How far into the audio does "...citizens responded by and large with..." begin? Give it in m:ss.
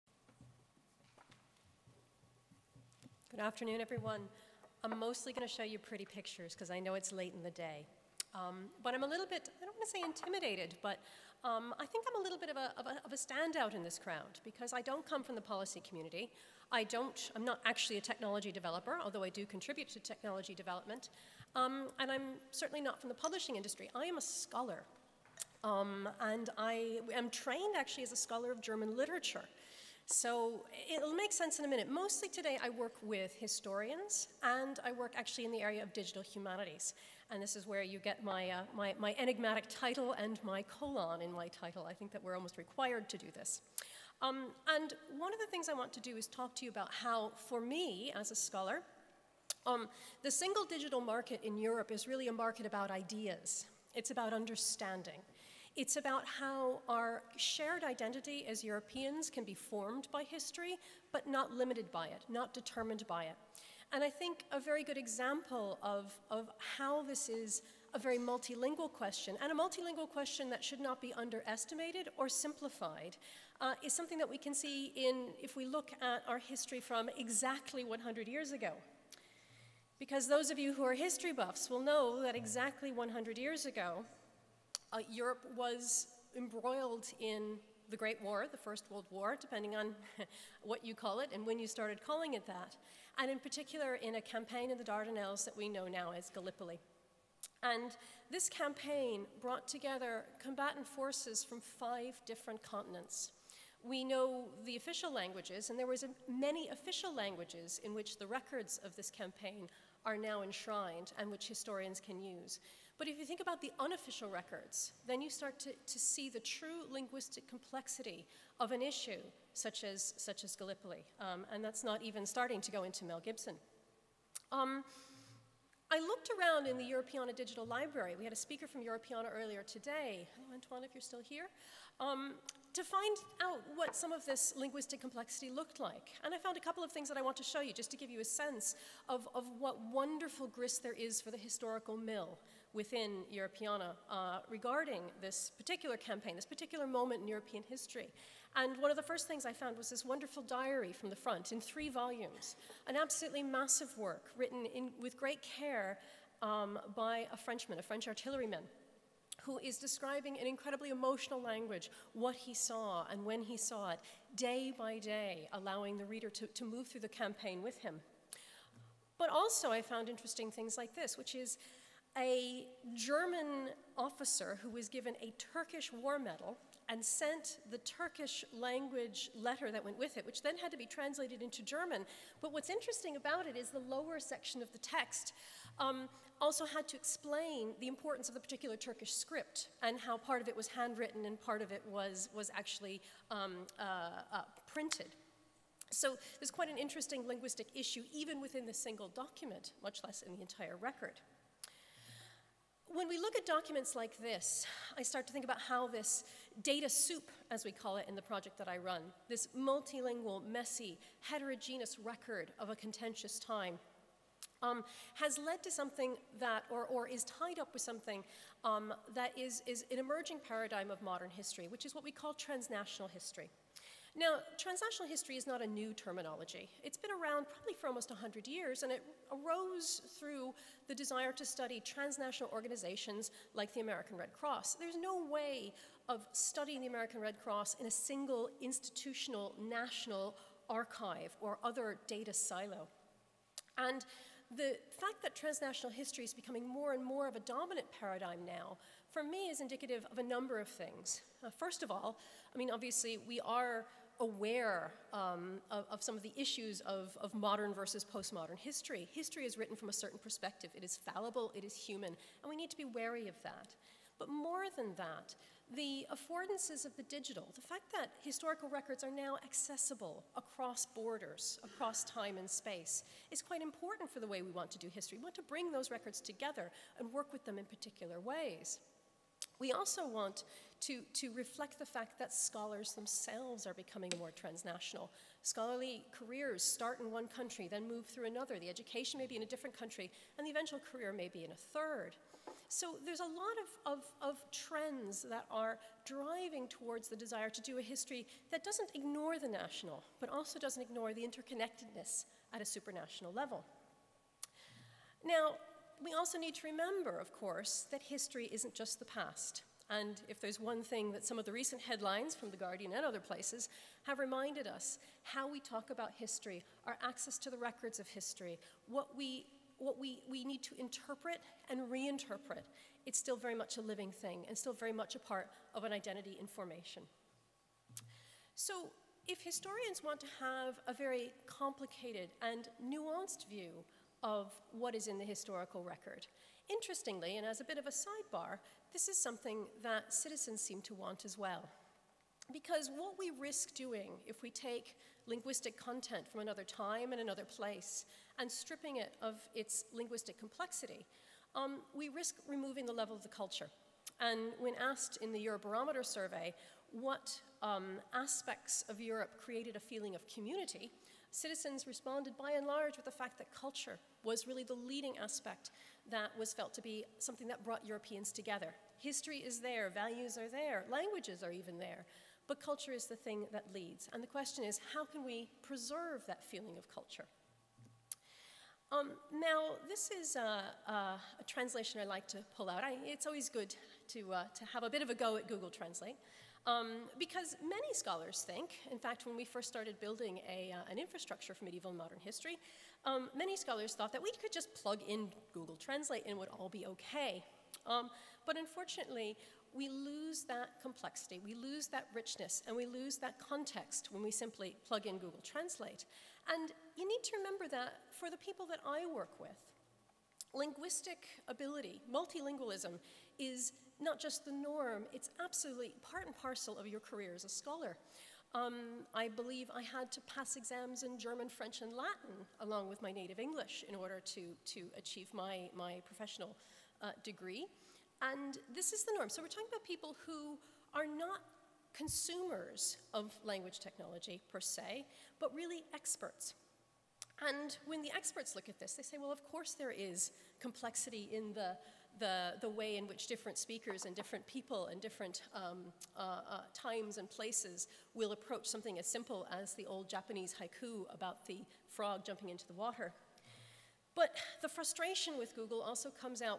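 6:01.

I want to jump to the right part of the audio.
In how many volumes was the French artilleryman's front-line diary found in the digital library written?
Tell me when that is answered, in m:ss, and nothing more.
2:31.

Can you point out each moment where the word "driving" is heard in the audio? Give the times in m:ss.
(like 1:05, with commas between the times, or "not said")
4:56.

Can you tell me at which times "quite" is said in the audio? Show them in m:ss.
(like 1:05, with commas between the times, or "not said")
3:16, 4:33.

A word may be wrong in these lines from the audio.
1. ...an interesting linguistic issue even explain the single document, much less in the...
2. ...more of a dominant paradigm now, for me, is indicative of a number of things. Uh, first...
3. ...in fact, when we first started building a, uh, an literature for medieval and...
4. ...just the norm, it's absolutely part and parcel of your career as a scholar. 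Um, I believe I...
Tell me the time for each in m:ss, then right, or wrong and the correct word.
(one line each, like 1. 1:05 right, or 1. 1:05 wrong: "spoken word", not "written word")
1. 3:16 wrong: "within", not "explain"
2. 4:07 right
3. 6:28 wrong: "infrastructure", not "literature"
4. 6:54 right.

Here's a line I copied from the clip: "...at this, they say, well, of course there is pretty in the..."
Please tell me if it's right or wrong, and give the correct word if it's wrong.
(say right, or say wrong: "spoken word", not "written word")
wrong: "complexity", not "pretty".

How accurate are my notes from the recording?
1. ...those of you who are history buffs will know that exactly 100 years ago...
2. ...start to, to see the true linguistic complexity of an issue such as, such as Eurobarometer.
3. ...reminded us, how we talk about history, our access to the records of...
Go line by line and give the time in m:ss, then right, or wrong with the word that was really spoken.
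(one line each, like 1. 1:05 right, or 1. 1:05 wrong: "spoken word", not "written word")
1. 1:20 right
2. 1:55 wrong: "Gallipoli", not "Eurobarometer"
3. 5:14 right.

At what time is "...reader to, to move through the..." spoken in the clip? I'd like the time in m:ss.
2:46.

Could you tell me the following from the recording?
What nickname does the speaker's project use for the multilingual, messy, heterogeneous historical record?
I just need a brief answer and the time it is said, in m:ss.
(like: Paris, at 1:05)
data soup, at 3:26.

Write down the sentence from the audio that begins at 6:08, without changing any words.
History is there, values are there, languages are even there, but culture is the thing that leads.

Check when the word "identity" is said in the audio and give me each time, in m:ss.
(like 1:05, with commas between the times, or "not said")
0:57, 5:25.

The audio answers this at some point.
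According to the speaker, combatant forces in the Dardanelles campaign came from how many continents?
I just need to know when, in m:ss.
1:41.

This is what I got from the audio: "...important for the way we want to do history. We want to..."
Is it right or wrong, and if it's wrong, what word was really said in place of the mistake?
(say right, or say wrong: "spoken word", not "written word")
right.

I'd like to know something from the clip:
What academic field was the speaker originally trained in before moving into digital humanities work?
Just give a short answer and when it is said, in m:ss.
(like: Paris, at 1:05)
German literature, at 0:28.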